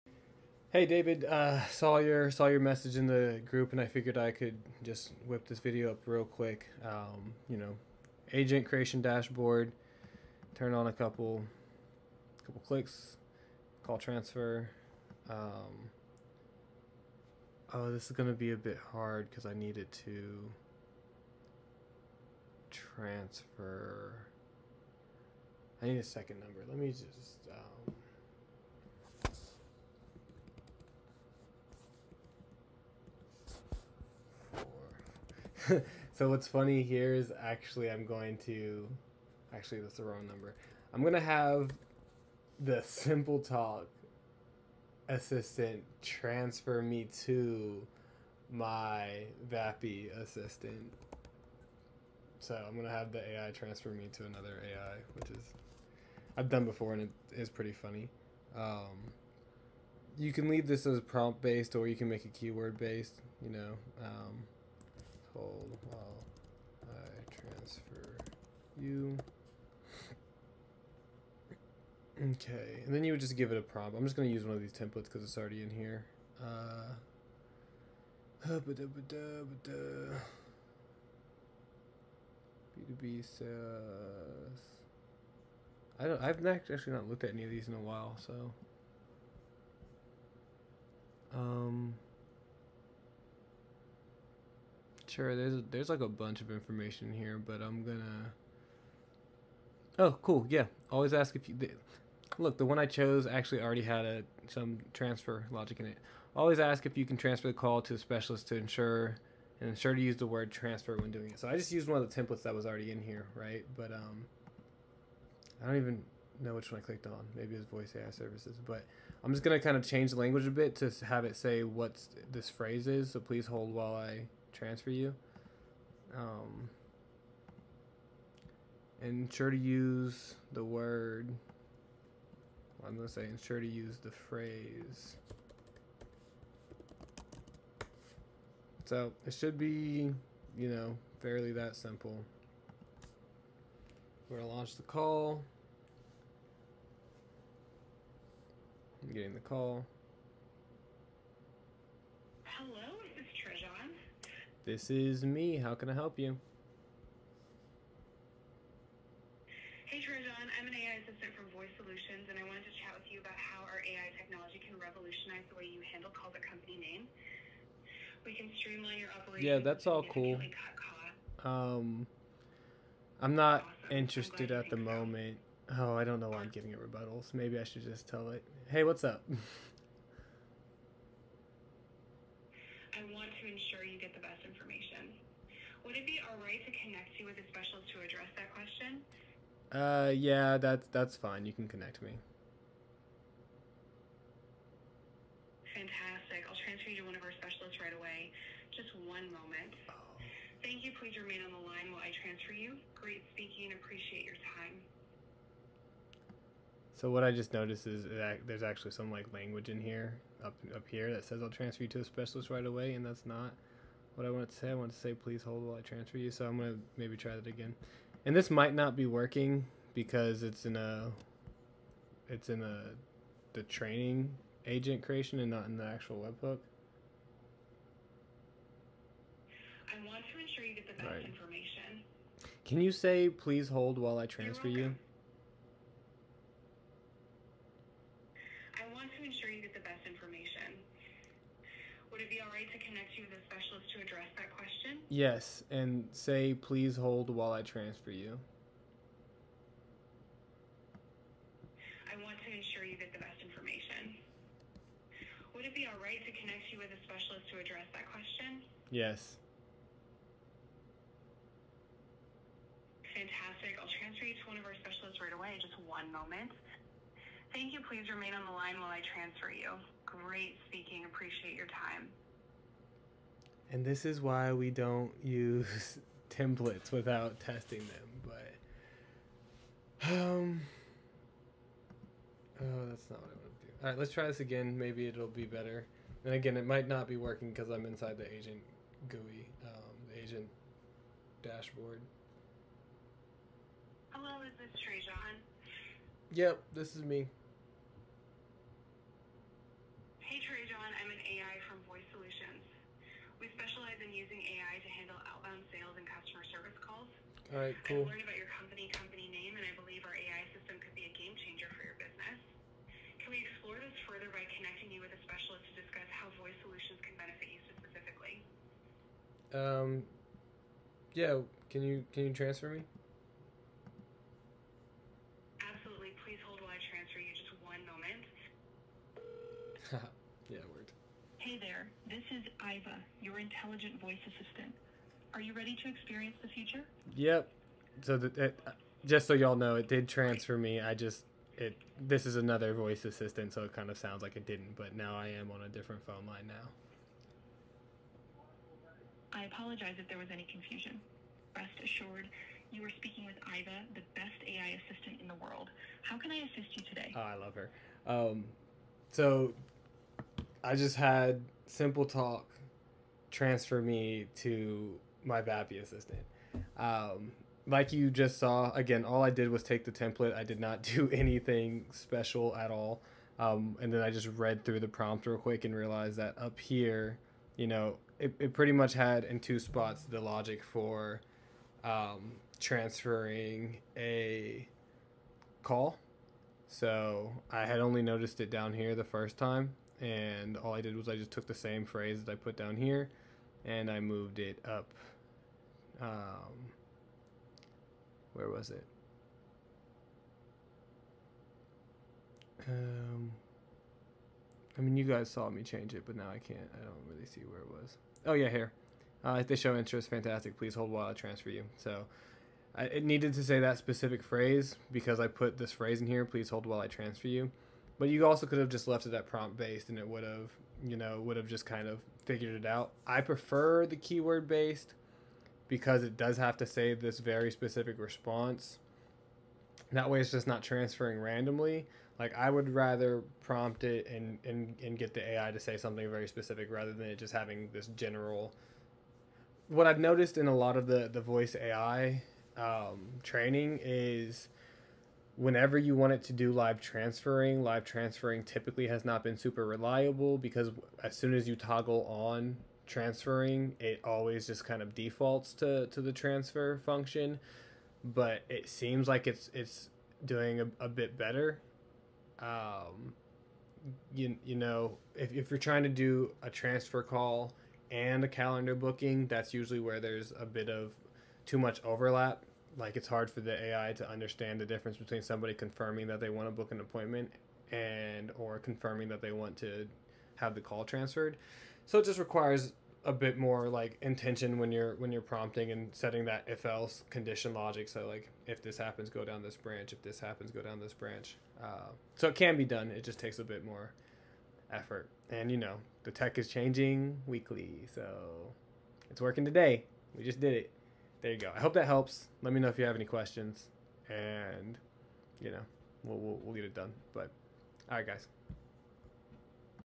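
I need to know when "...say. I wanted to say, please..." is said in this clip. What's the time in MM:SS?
03:34.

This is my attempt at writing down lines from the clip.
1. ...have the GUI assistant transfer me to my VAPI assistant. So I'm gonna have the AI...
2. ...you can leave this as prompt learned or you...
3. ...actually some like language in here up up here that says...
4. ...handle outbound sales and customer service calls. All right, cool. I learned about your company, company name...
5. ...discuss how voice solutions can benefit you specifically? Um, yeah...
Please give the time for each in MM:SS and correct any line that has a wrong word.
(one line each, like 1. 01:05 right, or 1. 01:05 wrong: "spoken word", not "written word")
1. 00:41 wrong: "SimpleTalk", not "GUI"
2. 01:00 wrong: "based", not "learned"
3. 03:28 right
4. 05:04 right
5. 05:15 right.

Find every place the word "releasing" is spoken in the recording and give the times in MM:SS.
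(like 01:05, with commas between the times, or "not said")
not said.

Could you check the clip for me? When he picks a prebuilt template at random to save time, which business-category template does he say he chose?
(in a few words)
B2B.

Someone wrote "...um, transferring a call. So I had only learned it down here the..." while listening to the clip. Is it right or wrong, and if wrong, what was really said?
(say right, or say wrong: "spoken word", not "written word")
wrong: "noticed", not "learned".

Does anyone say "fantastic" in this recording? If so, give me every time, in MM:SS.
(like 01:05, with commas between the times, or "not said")
03:15, 04:23, 06:50.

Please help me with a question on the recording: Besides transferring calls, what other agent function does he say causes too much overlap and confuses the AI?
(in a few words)
Calendar booking.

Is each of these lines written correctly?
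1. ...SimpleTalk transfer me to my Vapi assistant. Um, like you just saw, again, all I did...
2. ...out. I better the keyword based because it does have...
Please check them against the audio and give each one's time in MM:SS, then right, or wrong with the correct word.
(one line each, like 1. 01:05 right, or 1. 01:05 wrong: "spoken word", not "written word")
1. 06:01 right
2. 07:02 wrong: "prefer", not "better".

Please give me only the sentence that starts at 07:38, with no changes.
But it seems like it's it's doing a, a bit better.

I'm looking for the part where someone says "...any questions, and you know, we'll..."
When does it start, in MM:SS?
08:22.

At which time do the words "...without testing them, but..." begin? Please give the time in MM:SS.
04:36.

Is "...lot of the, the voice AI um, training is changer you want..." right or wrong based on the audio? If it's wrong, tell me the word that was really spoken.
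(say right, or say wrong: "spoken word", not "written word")
wrong: "whenever", not "changer".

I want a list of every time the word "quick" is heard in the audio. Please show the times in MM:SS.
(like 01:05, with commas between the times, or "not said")
00:06, 06:15.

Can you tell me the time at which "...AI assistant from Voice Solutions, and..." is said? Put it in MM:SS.
02:40.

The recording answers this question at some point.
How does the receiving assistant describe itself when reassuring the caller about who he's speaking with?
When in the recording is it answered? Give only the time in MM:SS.
05:53.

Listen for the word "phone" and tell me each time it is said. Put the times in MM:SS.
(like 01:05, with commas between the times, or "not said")
05:46.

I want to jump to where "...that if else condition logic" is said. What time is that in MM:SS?
08:06.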